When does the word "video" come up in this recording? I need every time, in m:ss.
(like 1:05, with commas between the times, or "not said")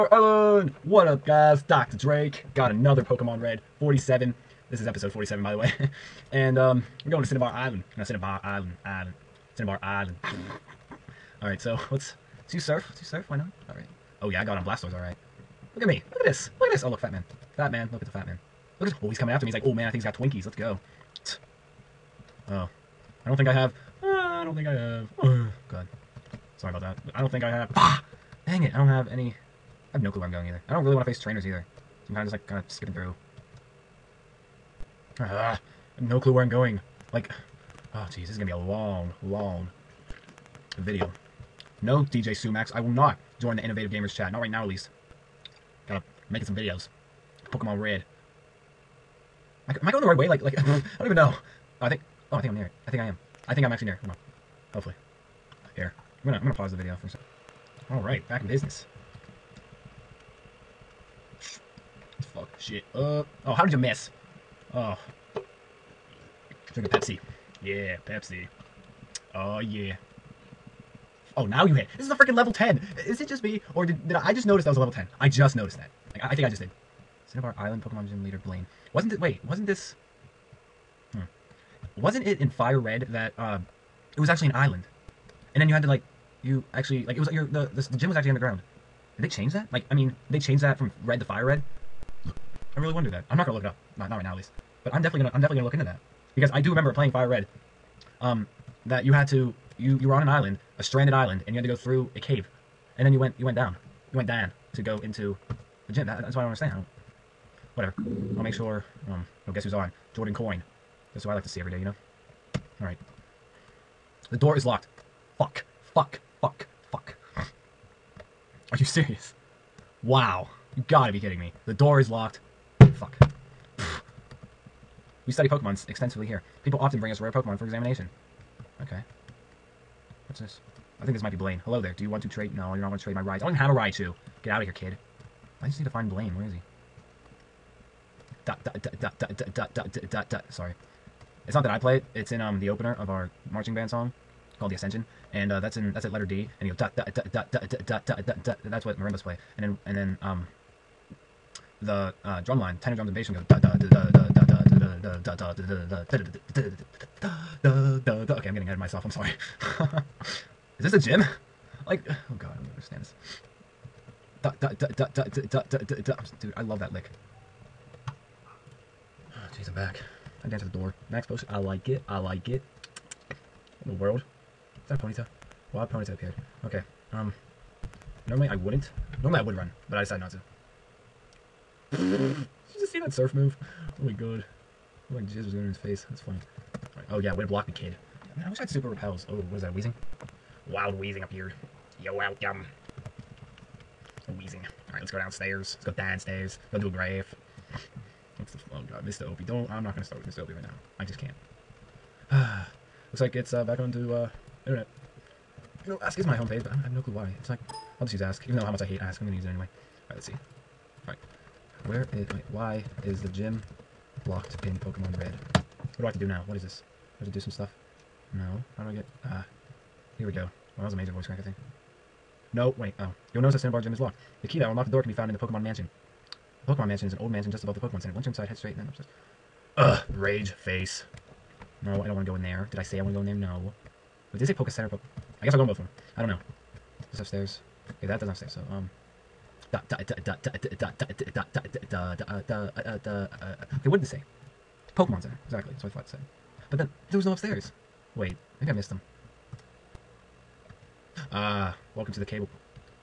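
0:40, 0:46, 0:56.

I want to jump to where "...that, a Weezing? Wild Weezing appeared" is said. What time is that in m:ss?
3:09.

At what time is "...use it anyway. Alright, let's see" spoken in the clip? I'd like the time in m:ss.
3:29.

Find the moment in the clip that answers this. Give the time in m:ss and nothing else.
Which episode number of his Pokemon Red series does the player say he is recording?
0:04.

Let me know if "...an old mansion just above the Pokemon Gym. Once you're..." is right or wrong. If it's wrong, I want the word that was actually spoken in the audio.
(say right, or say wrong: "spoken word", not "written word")
wrong: "Center", not "Gym".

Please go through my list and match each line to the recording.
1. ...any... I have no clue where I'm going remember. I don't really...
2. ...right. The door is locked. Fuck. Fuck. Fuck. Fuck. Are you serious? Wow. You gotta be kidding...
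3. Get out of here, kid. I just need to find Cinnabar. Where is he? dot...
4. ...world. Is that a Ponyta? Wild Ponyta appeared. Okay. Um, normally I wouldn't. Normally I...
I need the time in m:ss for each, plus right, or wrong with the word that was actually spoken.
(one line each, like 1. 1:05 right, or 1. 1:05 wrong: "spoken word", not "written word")
1. 0:29 wrong: "either", not "remember"
2. 1:52 right
3. 2:14 wrong: "Blaine", not "Cinnabar"
4. 2:54 right.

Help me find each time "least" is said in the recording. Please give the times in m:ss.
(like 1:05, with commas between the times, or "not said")
0:44, 1:34.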